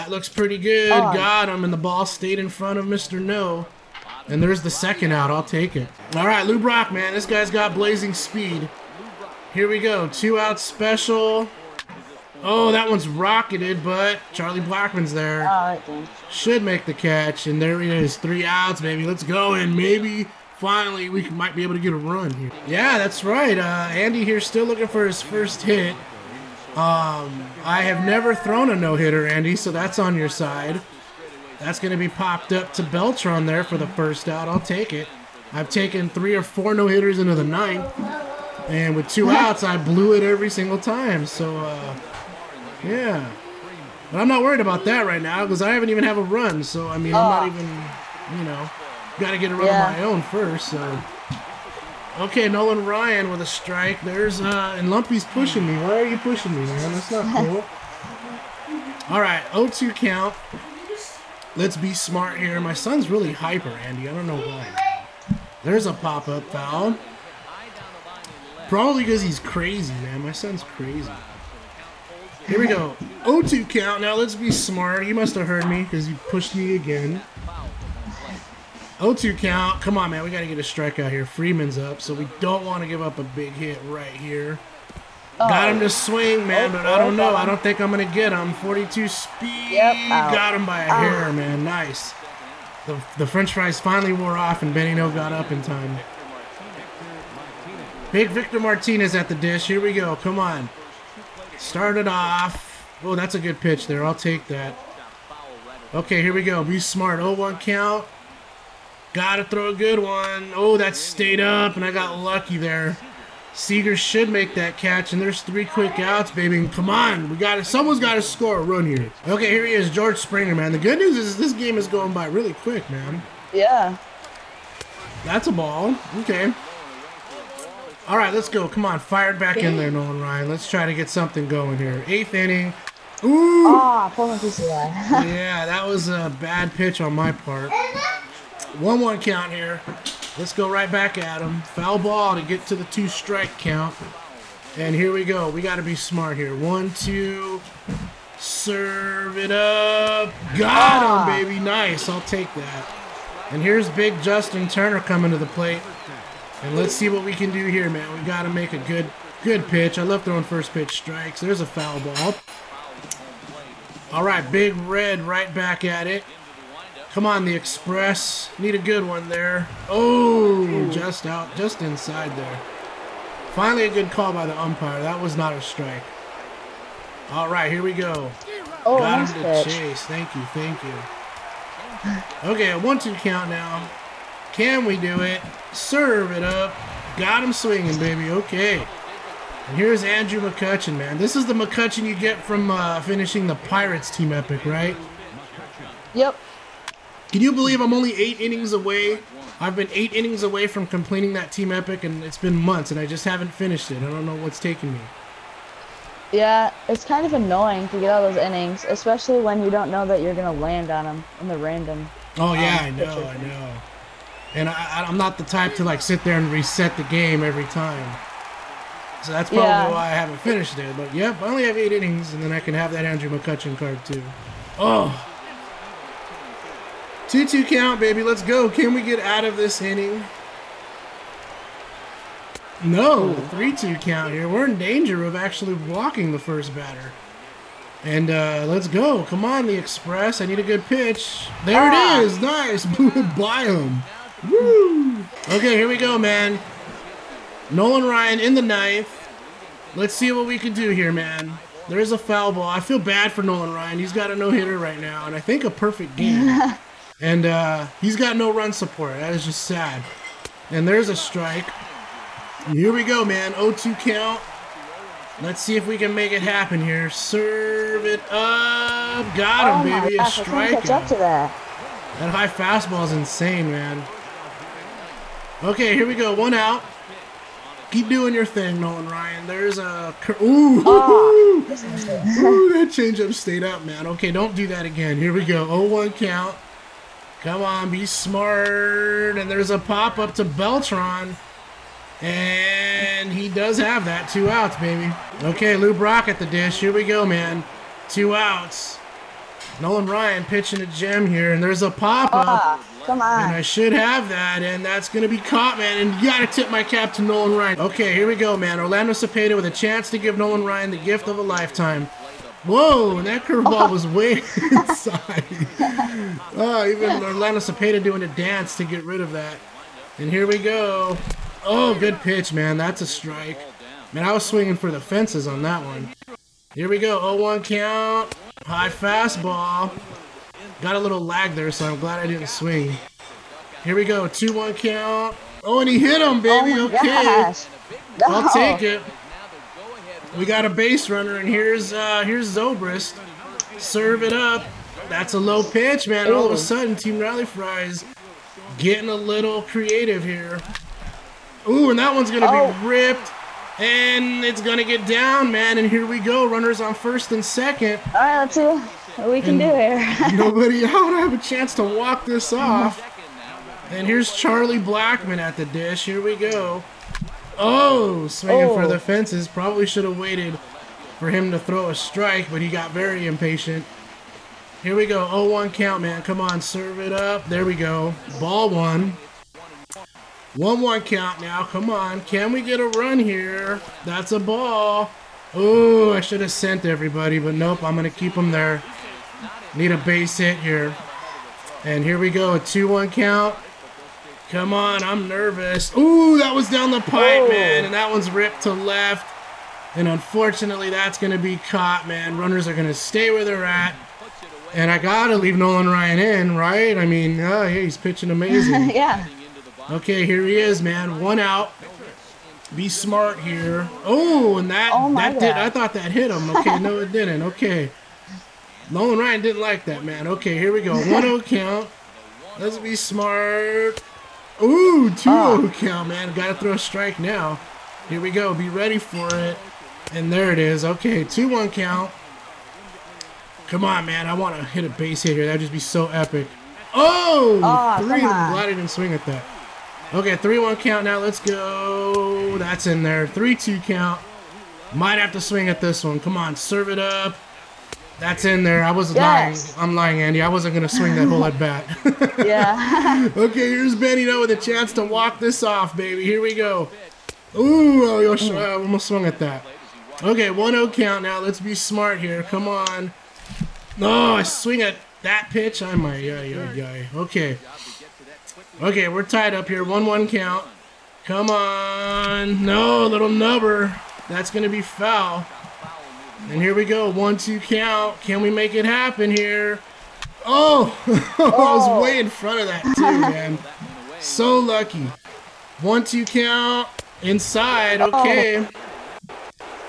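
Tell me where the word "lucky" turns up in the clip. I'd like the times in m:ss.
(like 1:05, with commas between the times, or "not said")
1:52, 8:04.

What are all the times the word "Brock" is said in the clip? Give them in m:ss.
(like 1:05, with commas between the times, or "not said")
0:06, 4:55.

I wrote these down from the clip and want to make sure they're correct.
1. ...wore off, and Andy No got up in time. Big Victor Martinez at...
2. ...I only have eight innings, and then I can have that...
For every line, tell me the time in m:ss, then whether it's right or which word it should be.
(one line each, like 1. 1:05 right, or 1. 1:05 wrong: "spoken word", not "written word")
1. 1:34 wrong: "Benny", not "Andy"
2. 3:41 right.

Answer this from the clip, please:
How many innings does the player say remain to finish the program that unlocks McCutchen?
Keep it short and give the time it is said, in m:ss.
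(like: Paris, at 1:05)
8, at 3:17.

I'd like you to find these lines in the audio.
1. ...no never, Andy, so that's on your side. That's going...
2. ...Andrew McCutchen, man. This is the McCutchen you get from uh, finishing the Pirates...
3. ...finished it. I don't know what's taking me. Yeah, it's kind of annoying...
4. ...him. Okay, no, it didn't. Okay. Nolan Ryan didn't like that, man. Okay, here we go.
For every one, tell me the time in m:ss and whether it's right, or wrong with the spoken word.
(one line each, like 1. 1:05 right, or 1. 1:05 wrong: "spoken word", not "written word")
1. 0:28 wrong: "hitter", not "never"
2. 3:10 right
3. 3:23 right
4. 6:56 right.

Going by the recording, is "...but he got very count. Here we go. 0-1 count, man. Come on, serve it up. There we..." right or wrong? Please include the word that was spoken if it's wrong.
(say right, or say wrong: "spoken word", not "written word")
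wrong: "impatient", not "count".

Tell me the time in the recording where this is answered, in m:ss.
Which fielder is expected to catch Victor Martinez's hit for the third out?
1:53.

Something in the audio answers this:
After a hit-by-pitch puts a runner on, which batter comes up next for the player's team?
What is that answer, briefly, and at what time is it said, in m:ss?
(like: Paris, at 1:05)
Zobrist, at 5:42.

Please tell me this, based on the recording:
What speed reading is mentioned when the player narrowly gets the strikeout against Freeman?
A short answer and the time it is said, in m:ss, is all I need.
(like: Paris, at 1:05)
42, at 1:28.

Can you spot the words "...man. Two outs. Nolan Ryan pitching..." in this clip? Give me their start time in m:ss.
4:57.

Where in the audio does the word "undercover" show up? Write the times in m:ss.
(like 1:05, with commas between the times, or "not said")
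not said.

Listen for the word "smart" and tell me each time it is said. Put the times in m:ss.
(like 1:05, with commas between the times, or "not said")
1:01, 1:14, 1:46, 2:25, 4:48, 6:52, 7:02, 7:41.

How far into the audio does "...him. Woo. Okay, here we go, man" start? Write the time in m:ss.
4:03.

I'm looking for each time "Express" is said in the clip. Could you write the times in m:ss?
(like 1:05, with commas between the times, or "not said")
2:47, 3:59.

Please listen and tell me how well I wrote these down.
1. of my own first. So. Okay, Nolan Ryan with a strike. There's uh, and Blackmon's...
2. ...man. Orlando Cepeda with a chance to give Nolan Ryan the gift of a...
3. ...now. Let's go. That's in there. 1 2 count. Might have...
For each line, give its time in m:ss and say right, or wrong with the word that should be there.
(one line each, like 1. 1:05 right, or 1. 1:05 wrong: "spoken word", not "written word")
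1. 0:49 wrong: "Lumpy", not "Blackmon"
2. 5:08 right
3. 7:21 wrong: "3", not "1".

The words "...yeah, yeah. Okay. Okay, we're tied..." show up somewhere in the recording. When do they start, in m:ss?
7:46.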